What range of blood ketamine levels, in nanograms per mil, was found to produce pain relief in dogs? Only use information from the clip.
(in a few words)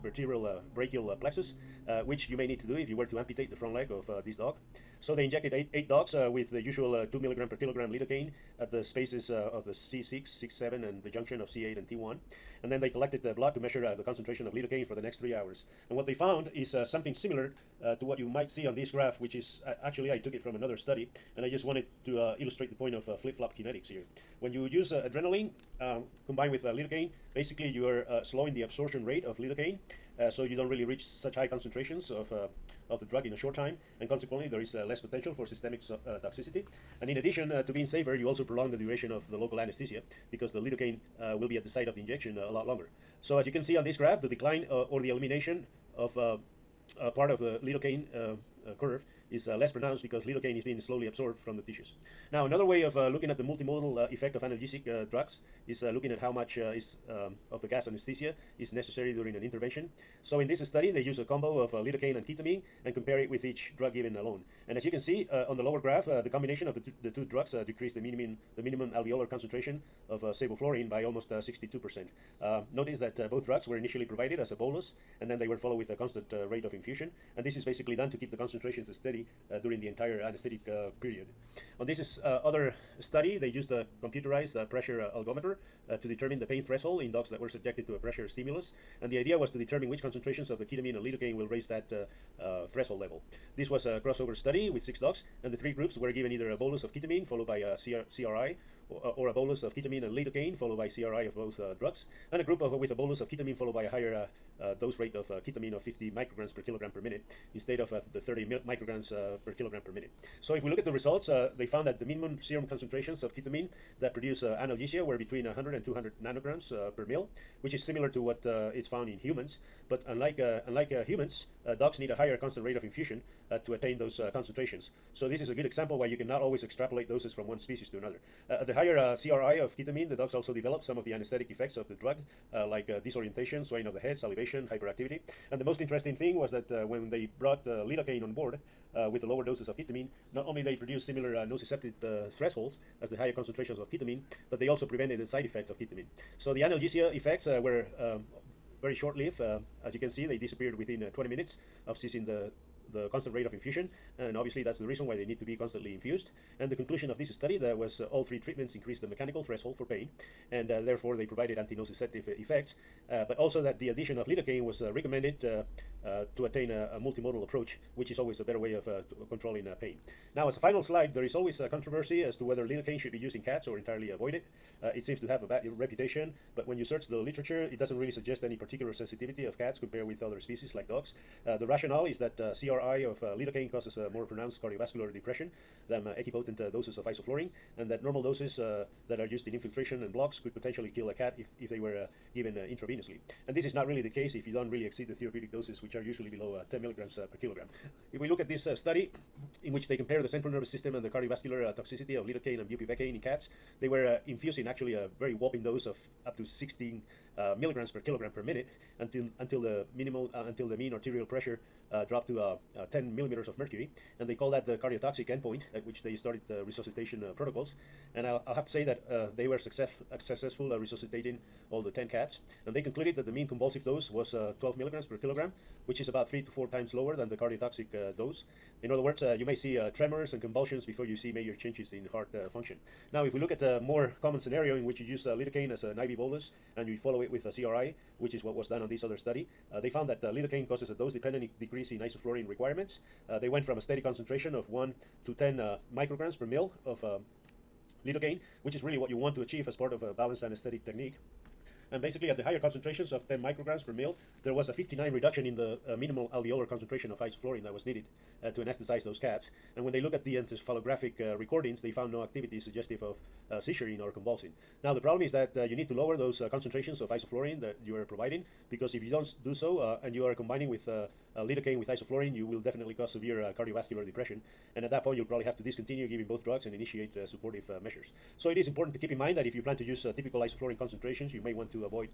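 100 to 200.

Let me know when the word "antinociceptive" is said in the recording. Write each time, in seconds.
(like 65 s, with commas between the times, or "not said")
161 s.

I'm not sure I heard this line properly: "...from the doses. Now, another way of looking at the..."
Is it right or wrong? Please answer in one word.
wrong.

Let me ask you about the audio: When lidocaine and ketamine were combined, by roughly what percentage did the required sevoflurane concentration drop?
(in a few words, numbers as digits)
62%.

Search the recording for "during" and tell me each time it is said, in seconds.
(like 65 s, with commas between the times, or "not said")
59 s, 79 s.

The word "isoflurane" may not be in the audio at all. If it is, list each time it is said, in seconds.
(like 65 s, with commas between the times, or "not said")
187 s, 241 s, 257 s, 267 s, 271 s, 280 s.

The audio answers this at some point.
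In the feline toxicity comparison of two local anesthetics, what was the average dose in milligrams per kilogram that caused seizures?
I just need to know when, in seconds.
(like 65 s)
224 s.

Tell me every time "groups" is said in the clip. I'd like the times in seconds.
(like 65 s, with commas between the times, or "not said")
95 s, 102 s.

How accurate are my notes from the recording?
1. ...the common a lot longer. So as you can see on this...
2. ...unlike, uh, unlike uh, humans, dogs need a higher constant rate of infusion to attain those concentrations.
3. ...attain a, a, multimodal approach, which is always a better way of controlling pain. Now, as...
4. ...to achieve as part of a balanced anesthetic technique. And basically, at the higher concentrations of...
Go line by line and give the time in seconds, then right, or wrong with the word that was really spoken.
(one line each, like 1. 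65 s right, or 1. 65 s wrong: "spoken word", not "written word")
1. 41 s wrong: "injection", not "common"
2. 120 s right
3. 166 s right
4. 249 s right.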